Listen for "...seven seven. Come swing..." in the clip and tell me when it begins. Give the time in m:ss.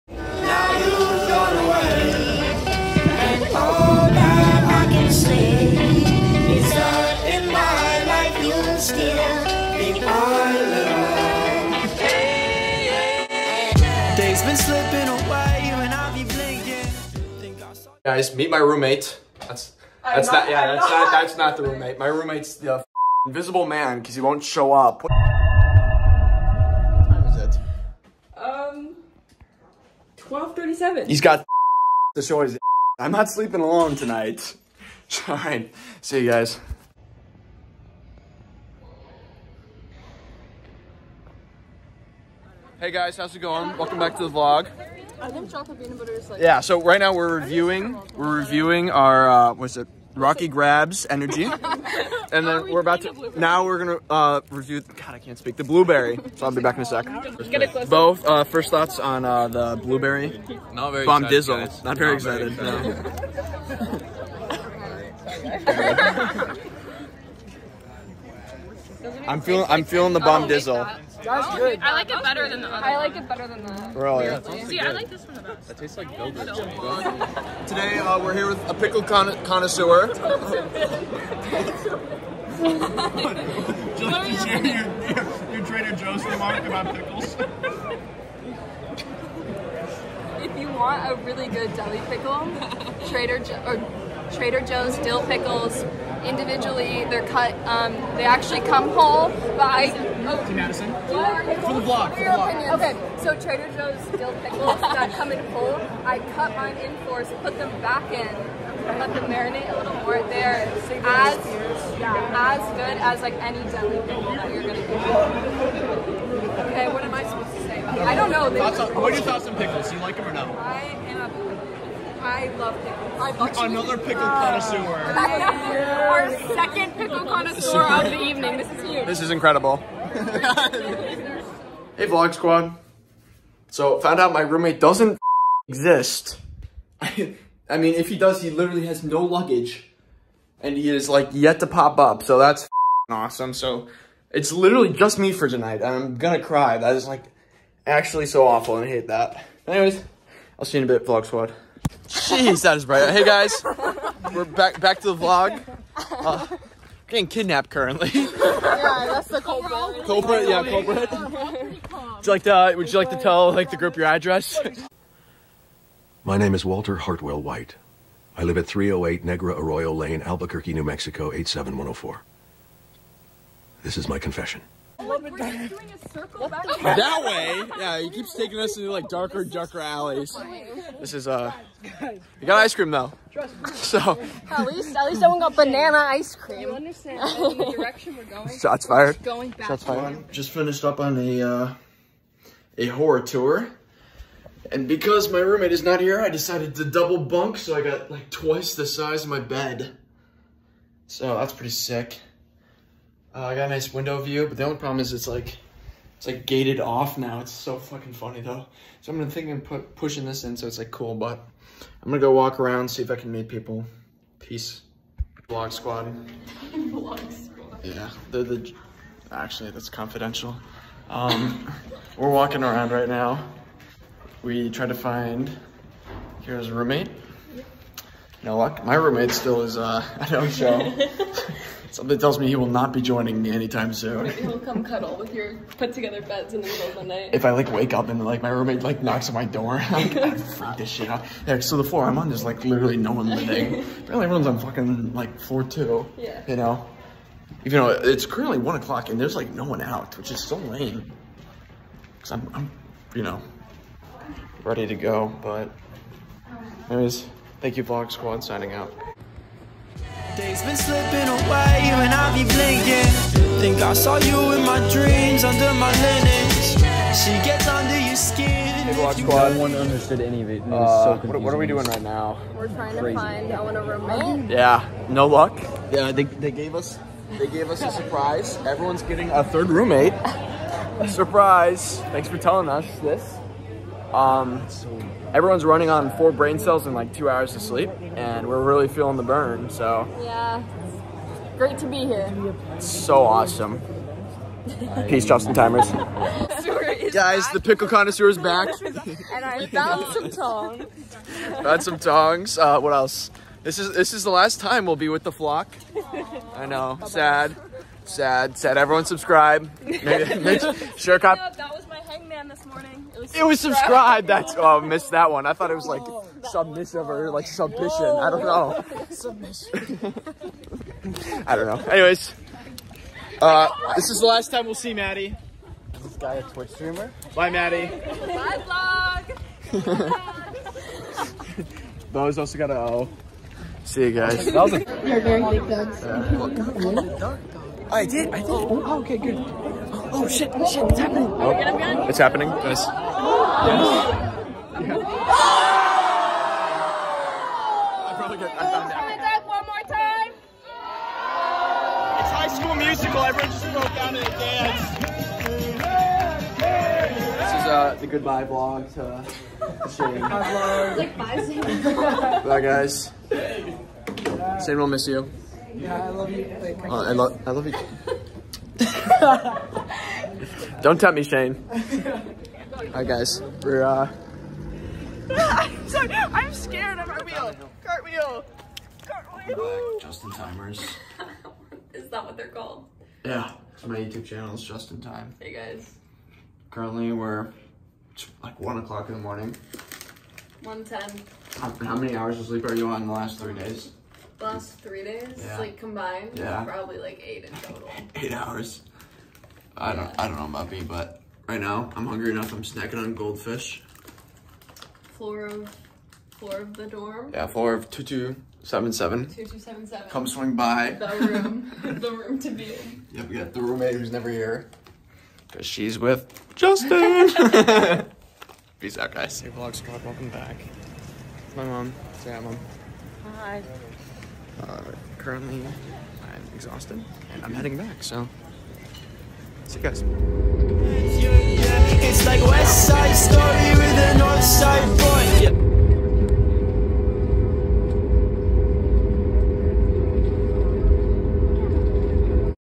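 6:49.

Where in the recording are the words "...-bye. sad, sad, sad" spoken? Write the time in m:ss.
5:07.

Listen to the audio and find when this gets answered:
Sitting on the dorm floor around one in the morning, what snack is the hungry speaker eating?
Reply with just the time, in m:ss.
6:43.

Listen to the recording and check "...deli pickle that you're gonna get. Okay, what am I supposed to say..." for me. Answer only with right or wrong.
right.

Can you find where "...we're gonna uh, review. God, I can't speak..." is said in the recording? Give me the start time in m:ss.
0:53.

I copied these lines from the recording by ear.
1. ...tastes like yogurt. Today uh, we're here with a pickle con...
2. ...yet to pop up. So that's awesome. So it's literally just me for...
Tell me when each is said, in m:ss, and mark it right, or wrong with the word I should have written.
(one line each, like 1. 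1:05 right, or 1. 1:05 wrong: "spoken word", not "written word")
1. 1:15 right
2. 2:21 right.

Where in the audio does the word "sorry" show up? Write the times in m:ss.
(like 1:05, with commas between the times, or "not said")
6:15.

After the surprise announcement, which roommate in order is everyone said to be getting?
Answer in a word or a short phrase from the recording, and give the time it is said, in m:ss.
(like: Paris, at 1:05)
third, at 4:39.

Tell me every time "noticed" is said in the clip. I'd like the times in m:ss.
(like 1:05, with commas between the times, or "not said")
not said.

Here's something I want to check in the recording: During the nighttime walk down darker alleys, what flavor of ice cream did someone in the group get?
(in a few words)
banana.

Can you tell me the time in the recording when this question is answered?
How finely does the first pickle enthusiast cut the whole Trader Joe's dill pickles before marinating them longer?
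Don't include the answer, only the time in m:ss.
1:47.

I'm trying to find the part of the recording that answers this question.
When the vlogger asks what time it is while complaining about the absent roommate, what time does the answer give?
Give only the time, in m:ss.
0:30.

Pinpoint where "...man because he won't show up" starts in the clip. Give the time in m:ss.
0:23.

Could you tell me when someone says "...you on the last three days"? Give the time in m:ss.
6:32.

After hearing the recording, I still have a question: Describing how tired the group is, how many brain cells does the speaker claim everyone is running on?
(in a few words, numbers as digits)
4.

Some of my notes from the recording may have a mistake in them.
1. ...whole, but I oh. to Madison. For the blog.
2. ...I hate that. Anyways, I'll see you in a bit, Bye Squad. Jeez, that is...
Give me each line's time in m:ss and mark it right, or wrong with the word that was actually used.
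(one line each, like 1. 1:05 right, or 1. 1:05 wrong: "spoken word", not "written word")
1. 1:38 right
2. 2:28 wrong: "Vlog", not "Bye".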